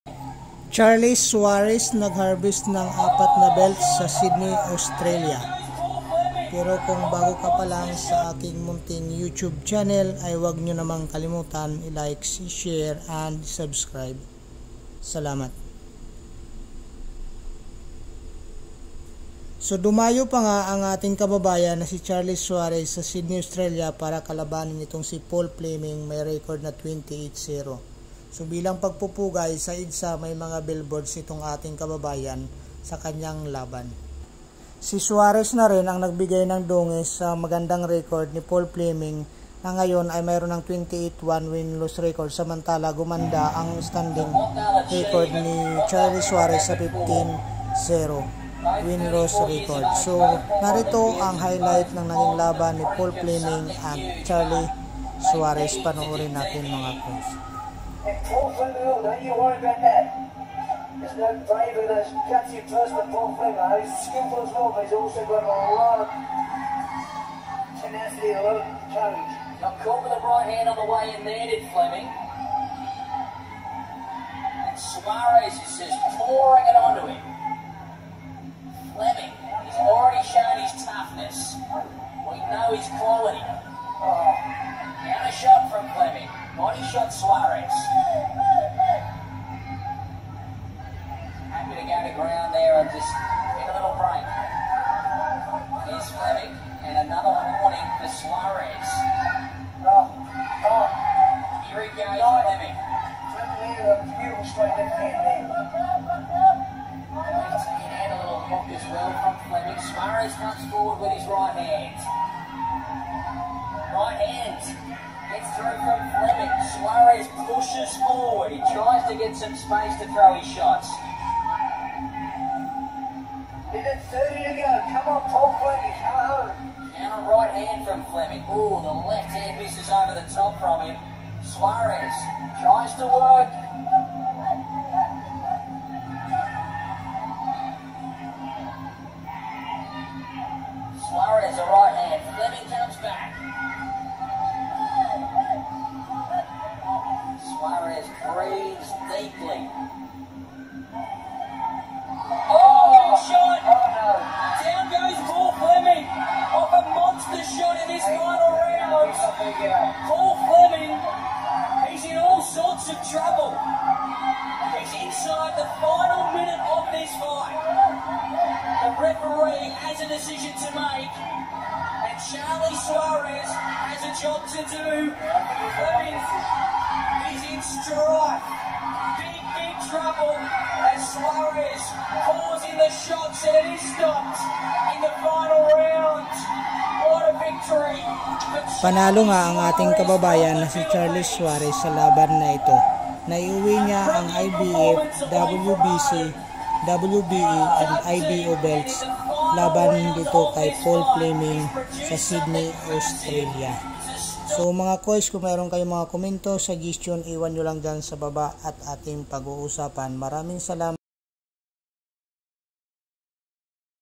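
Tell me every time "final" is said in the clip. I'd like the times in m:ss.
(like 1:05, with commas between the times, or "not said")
2:38, 2:45, 3:05.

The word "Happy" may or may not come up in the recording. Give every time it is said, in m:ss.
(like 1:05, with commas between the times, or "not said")
1:27.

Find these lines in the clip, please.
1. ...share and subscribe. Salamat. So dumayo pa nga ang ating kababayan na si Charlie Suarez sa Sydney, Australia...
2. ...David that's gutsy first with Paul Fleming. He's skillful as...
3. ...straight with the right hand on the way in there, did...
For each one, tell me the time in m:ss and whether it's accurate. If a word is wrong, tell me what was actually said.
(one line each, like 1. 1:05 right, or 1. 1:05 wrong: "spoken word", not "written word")
1. 0:12 right
2. 1:01 right
3. 1:09 wrong: "caught", not "straight".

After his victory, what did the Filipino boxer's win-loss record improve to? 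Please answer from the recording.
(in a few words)
15-0.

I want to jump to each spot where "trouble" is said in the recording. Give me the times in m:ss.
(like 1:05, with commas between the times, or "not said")
2:43, 2:59.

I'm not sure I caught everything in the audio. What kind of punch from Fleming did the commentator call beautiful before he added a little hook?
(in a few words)
Straight left hand.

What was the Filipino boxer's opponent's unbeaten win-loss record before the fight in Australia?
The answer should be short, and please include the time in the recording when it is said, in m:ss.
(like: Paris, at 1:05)
28-0, at 0:26.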